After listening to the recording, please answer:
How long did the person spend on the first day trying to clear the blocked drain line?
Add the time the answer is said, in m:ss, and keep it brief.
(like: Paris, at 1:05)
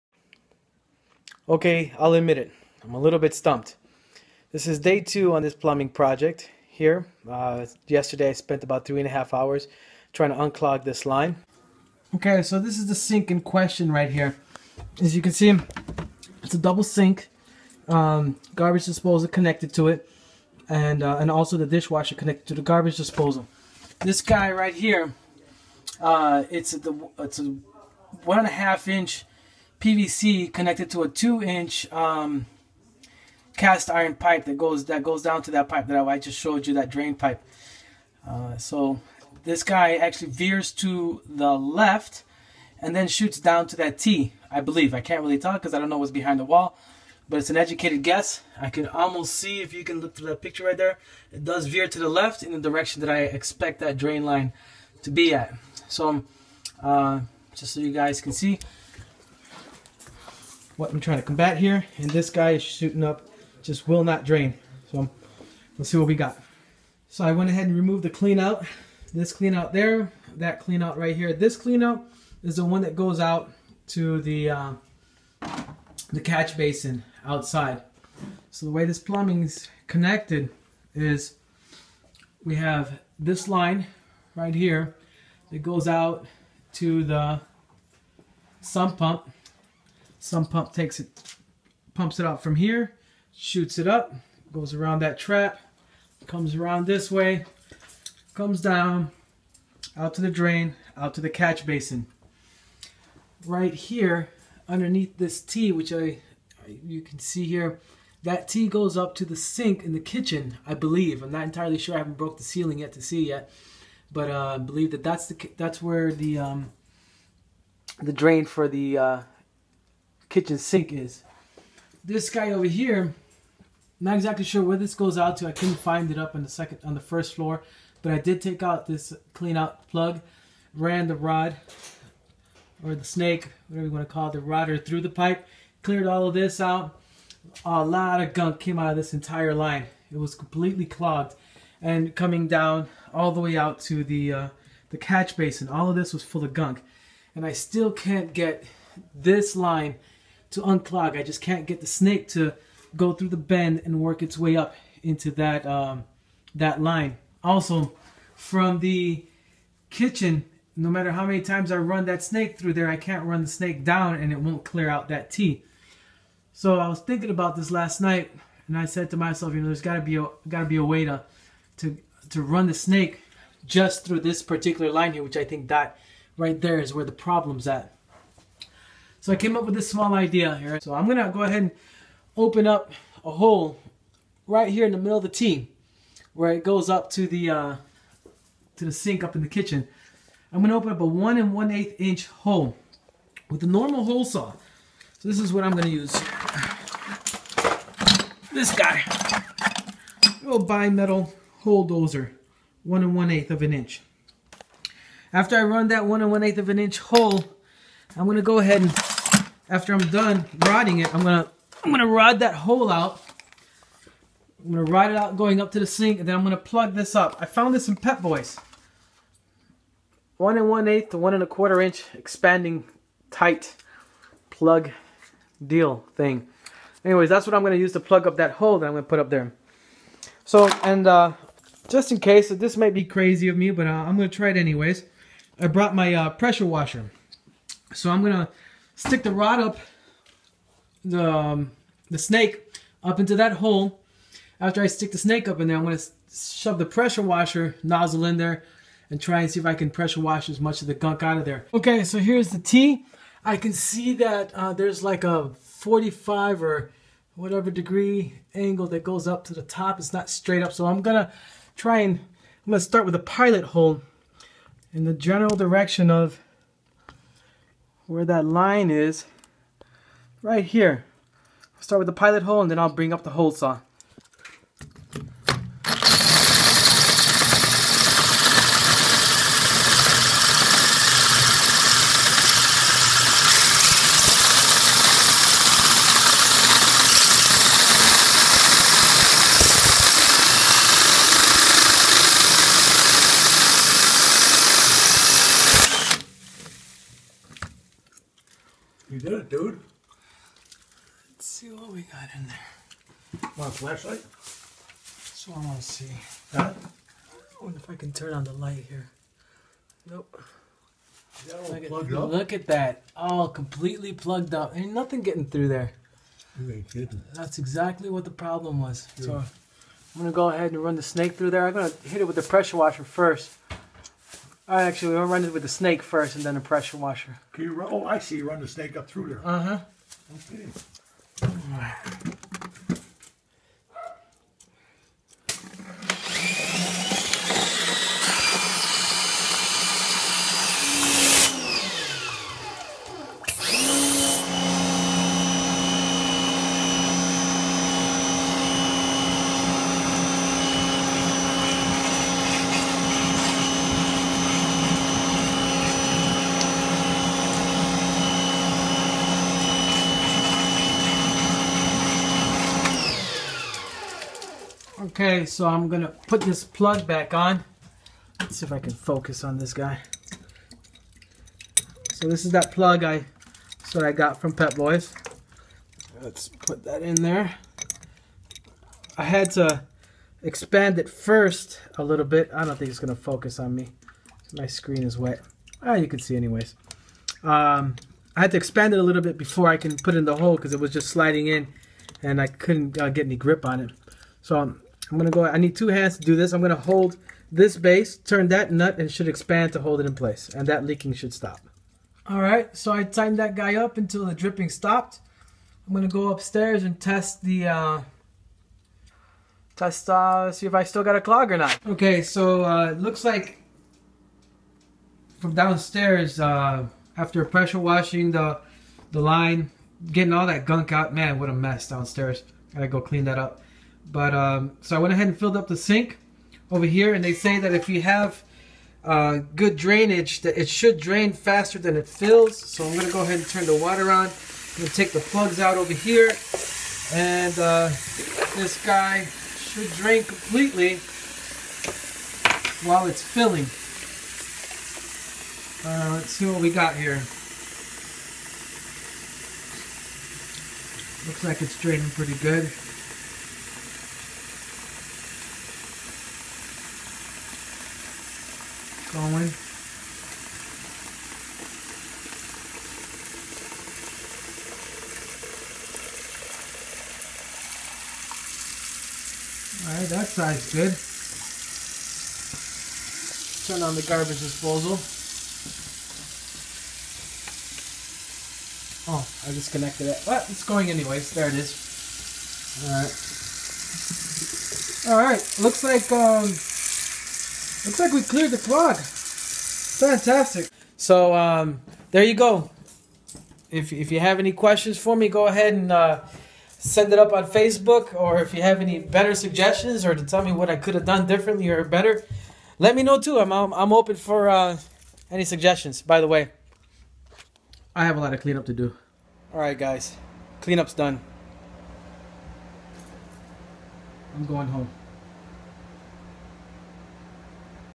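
3.5 hours, at 0:08.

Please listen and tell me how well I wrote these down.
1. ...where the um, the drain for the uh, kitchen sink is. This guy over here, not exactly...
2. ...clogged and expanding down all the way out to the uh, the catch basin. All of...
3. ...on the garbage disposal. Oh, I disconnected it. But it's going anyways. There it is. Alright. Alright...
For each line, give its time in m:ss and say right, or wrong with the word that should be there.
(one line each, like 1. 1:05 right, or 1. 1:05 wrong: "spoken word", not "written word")
1. 1:55 right
2. 2:20 wrong: "coming", not "expanding"
3. 7:53 right.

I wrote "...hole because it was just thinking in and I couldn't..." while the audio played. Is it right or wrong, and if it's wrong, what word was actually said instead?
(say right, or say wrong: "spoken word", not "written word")
wrong: "sliding", not "thinking".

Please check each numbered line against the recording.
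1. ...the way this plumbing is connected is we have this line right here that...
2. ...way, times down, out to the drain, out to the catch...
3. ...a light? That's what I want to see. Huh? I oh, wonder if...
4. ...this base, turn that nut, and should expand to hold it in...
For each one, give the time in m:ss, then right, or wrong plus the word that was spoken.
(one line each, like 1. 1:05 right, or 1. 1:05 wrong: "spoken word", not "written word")
1. 1:18 right
2. 1:37 wrong: "comes", not "times"
3. 5:03 wrong: "flashlight", not "light"
4. 6:37 right.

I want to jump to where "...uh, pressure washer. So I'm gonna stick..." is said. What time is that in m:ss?
3:56.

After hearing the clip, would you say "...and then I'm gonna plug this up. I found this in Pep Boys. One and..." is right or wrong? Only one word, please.
right.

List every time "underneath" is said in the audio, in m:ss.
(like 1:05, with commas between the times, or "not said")
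1:44.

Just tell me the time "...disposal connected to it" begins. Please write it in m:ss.
0:18.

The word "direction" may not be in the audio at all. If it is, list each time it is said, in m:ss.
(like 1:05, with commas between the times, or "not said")
0:52, 4:25.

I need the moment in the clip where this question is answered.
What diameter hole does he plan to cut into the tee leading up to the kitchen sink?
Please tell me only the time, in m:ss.
3:11.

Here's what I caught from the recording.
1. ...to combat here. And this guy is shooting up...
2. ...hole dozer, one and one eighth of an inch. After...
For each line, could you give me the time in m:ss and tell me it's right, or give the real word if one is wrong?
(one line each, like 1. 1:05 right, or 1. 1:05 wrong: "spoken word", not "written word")
1. 1:01 right
2. 3:21 right.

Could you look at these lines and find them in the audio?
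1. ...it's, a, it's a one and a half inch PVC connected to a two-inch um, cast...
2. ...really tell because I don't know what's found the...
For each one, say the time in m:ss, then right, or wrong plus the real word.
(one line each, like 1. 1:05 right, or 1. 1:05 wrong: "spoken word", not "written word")
1. 0:26 right
2. 0:45 wrong: "behind", not "found".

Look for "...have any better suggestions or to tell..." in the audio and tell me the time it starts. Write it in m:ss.
8:18.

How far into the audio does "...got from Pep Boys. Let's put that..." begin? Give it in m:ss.
6:14.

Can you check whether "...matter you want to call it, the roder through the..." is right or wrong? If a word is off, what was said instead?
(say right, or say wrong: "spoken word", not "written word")
wrong: "whatever", not "matter".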